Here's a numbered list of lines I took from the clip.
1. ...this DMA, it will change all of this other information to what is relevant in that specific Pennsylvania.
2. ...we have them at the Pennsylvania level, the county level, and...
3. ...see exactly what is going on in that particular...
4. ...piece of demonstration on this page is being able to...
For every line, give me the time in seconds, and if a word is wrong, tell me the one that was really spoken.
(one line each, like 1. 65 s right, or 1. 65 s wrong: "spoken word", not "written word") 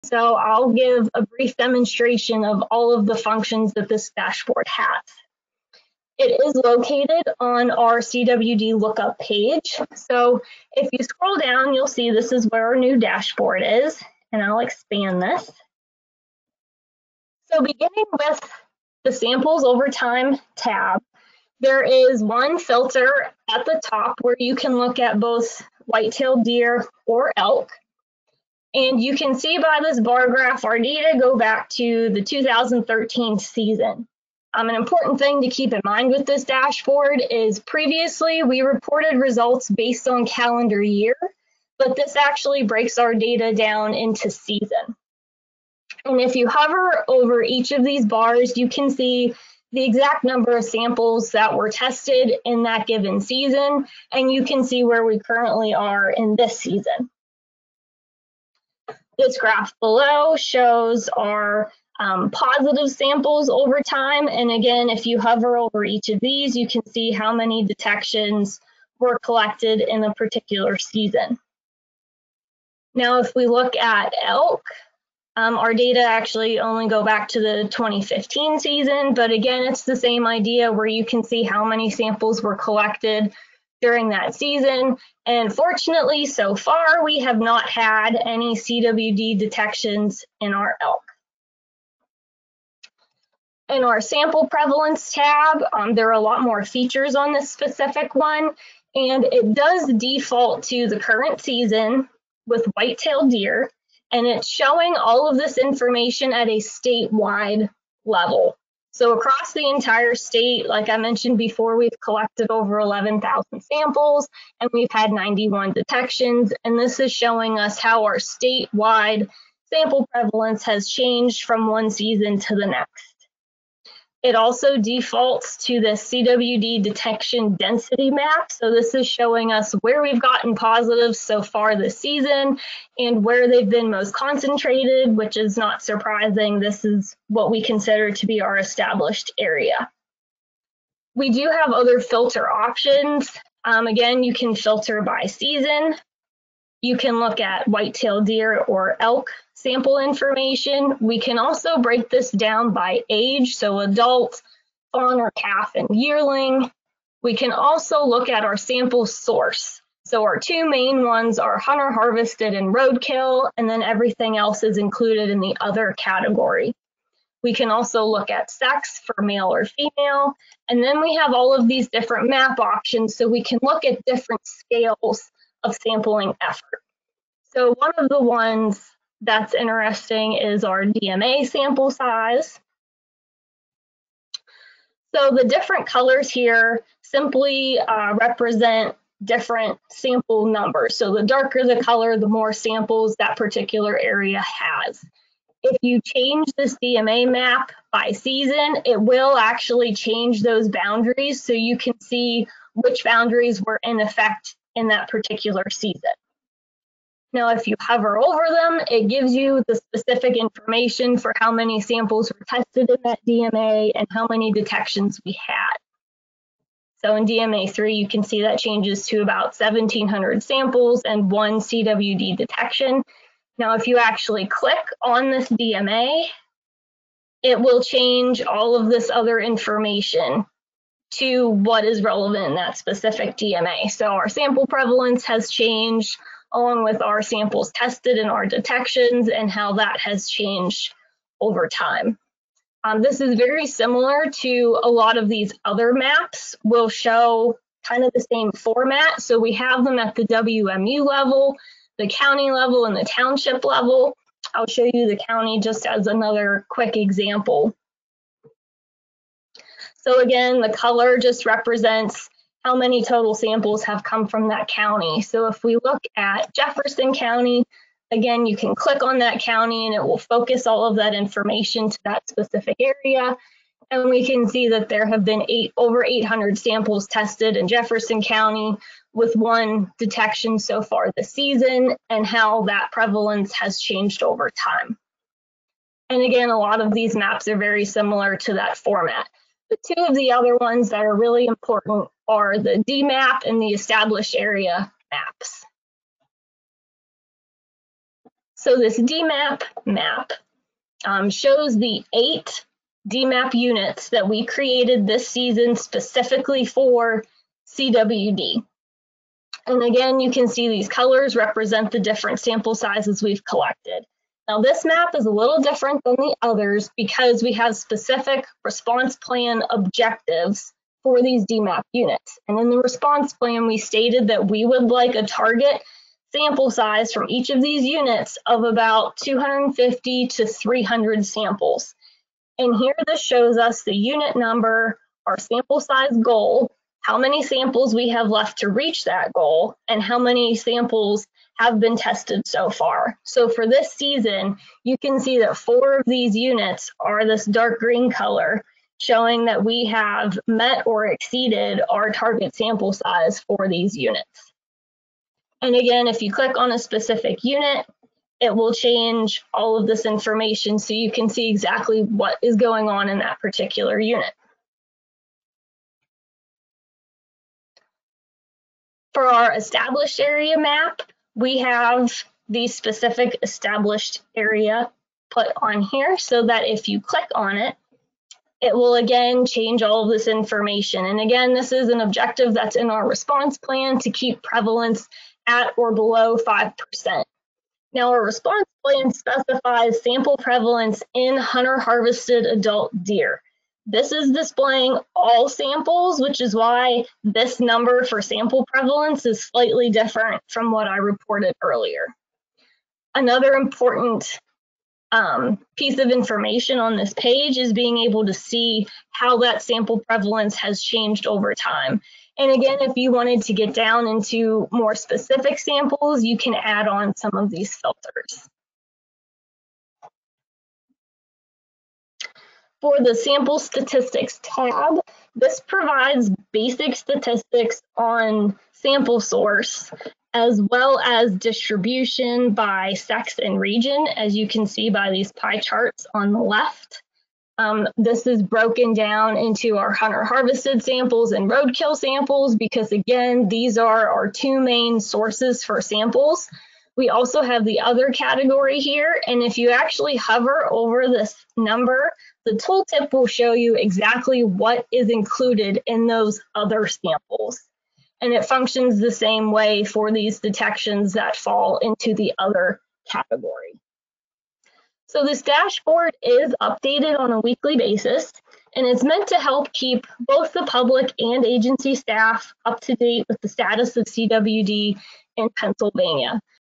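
1. 225 s wrong: "DMA", not "Pennsylvania"
2. 249 s wrong: "WMU", not "Pennsylvania"
3. 361 s right
4. 405 s wrong: "information", not "demonstration".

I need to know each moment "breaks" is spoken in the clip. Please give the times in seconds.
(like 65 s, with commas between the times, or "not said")
42 s, 151 s.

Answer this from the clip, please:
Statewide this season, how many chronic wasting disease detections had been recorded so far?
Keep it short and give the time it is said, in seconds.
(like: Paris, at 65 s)
91, at 115 s.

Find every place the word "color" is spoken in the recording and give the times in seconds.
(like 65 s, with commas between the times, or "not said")
185 s, 191 s, 260 s, 310 s, 348 s.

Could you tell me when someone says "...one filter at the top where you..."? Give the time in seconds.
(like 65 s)
22 s.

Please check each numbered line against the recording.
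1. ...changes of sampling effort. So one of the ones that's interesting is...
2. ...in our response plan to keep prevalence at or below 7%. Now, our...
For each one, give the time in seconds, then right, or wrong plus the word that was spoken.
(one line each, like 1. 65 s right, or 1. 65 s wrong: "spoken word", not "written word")
1. 174 s wrong: "scales", not "changes"
2. 382 s wrong: "5", not "7".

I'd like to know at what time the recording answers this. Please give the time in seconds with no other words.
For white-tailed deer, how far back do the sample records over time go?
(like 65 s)
32 s.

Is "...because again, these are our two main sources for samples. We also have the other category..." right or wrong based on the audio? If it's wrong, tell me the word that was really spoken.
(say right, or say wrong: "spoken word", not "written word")
right.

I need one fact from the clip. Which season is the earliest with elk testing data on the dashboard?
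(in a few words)
2015 season.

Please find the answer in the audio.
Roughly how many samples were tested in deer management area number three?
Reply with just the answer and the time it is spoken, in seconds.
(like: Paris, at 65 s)
1,700, at 219 s.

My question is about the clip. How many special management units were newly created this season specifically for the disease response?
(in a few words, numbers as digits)
8.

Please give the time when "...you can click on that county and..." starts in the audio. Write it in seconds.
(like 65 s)
268 s.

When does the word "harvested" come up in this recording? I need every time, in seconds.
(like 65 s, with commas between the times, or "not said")
161 s, 391 s, 440 s.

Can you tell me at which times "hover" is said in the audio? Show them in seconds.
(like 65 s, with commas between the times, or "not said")
46 s, 65 s, 207 s, 450 s.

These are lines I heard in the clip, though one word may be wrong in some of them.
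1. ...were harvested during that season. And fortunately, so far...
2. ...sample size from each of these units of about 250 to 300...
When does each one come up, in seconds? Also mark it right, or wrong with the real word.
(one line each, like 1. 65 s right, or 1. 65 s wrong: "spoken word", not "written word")
1. 82 s wrong: "collected", not "harvested"
2. 326 s right.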